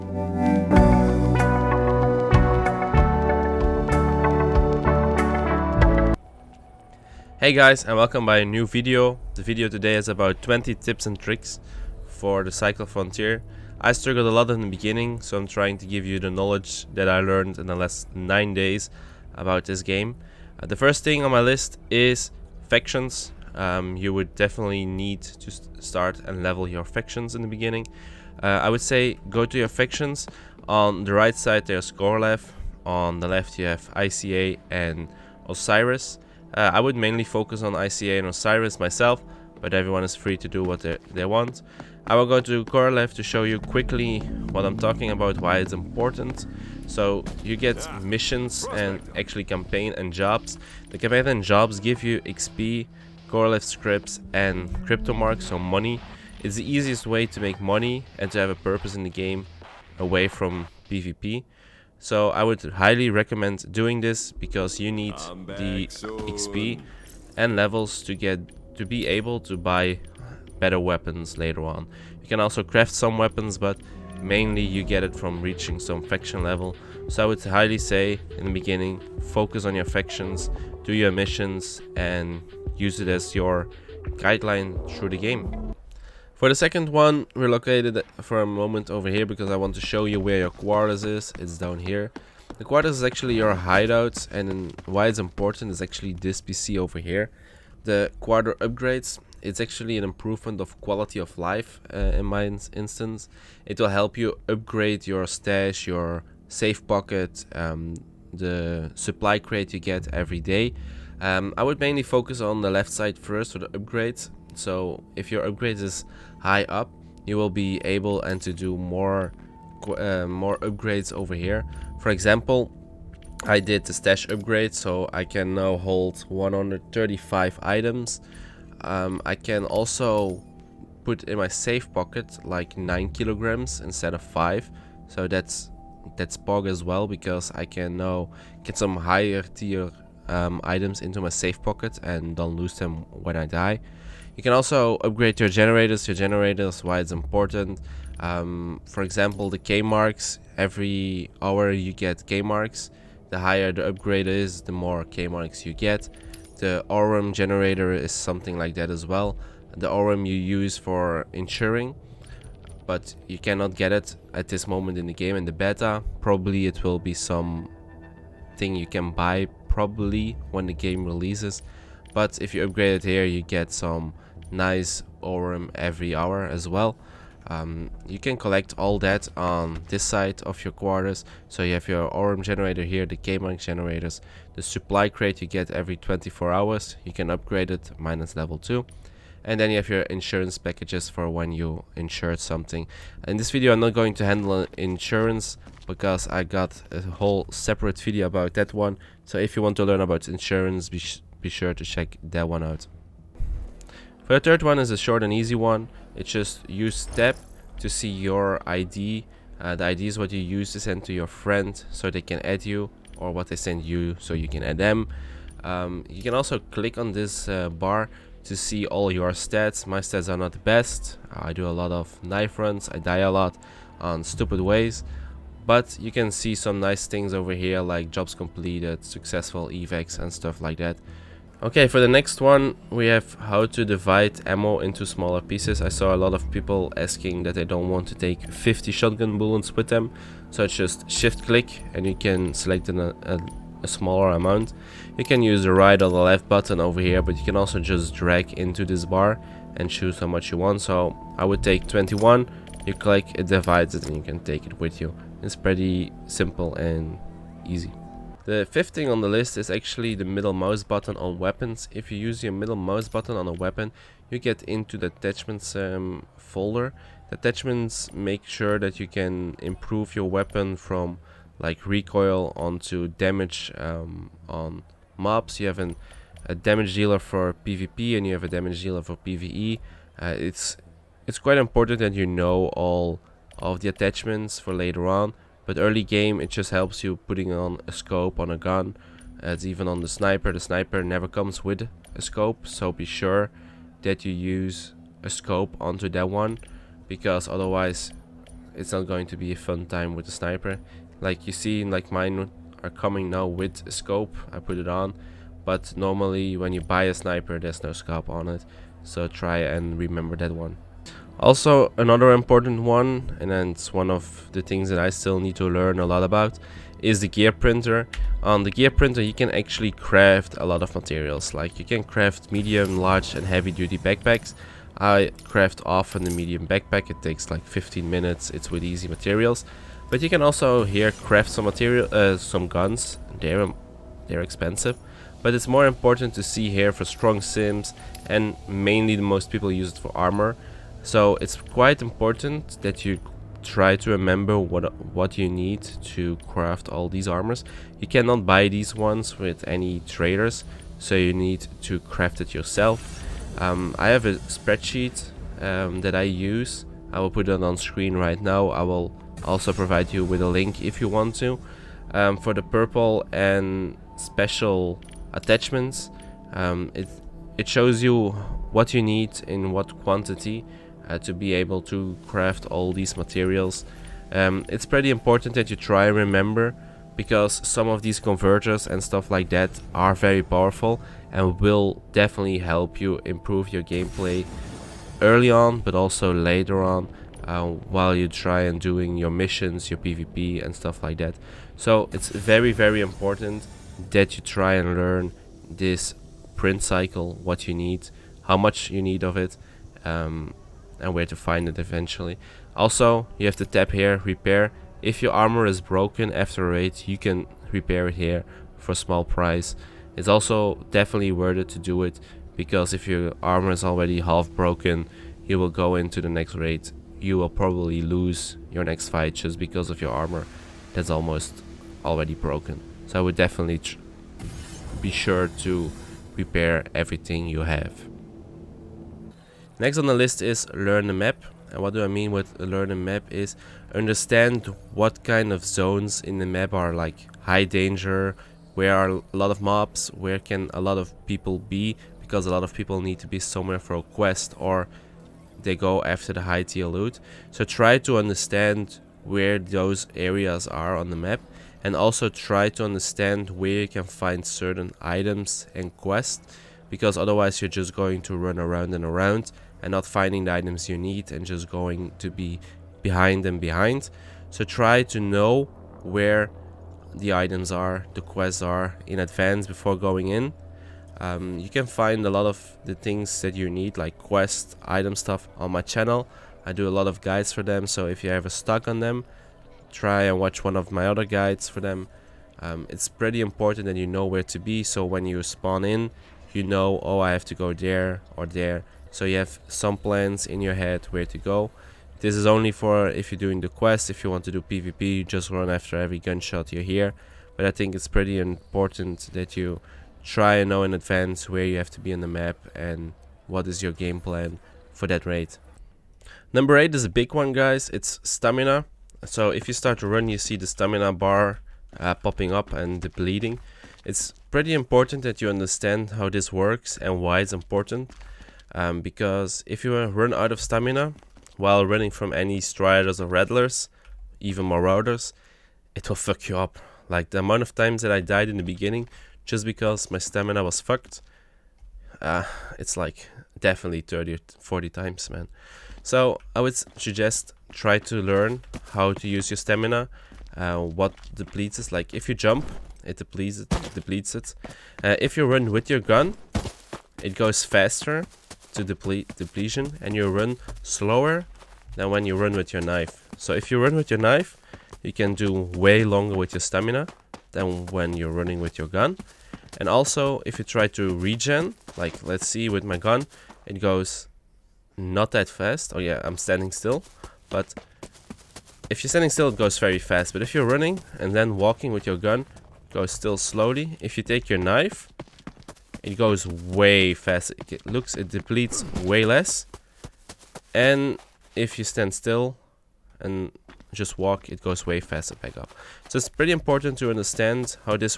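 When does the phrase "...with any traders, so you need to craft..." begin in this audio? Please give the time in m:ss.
5:49.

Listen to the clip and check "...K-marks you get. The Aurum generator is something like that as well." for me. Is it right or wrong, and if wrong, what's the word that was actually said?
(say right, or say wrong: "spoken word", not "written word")
right.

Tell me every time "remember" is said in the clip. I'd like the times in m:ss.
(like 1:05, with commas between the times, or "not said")
5:09, 5:44, 6:16.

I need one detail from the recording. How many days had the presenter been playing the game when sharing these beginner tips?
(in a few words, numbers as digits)
9.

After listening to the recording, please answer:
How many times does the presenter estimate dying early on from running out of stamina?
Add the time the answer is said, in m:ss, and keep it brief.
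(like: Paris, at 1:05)
30 or 40, at 8:54.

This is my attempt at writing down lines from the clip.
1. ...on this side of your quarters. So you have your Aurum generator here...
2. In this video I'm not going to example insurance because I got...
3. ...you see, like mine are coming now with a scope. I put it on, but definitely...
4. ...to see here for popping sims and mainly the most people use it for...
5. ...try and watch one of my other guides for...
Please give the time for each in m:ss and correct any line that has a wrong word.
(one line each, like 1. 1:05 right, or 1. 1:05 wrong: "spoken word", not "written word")
1. 2:59 right
2. 3:13 wrong: "handle", not "example"
3. 5:01 wrong: "normally", not "definitely"
4. 5:36 wrong: "strong", not "popping"
5. 7:59 right.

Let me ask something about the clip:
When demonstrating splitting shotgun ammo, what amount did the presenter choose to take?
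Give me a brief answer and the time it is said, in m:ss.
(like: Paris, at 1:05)
21, at 4:11.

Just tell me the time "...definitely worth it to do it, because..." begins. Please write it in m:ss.
6:50.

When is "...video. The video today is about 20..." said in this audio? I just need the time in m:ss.
0:08.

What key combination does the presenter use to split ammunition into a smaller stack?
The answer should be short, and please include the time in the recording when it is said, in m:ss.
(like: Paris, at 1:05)
Shift click, at 4:01.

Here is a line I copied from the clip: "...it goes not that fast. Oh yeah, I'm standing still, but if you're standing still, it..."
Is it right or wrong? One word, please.
right.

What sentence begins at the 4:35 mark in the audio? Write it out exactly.
You have an, a damage dealer for PvP and you have a damage dealer for PvE.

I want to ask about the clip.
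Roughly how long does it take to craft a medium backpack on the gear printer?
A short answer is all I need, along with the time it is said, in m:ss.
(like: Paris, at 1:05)
15 minutes, at 5:27.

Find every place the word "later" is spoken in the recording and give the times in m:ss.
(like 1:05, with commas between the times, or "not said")
1:11, 4:44, 6:26.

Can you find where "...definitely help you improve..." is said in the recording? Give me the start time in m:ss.
6:22.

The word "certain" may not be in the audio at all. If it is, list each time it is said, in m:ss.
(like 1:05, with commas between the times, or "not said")
7:34.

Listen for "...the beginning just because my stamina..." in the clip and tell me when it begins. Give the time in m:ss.
8:48.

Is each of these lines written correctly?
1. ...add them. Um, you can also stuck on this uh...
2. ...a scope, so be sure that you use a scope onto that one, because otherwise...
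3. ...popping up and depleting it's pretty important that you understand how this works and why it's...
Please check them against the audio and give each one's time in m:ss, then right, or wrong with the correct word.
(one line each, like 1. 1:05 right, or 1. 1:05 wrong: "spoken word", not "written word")
1. 3:34 wrong: "click", not "stuck"
2. 4:52 right
3. 8:32 right.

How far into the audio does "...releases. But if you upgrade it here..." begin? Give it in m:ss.
2:51.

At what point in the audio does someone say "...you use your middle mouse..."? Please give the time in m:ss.
4:22.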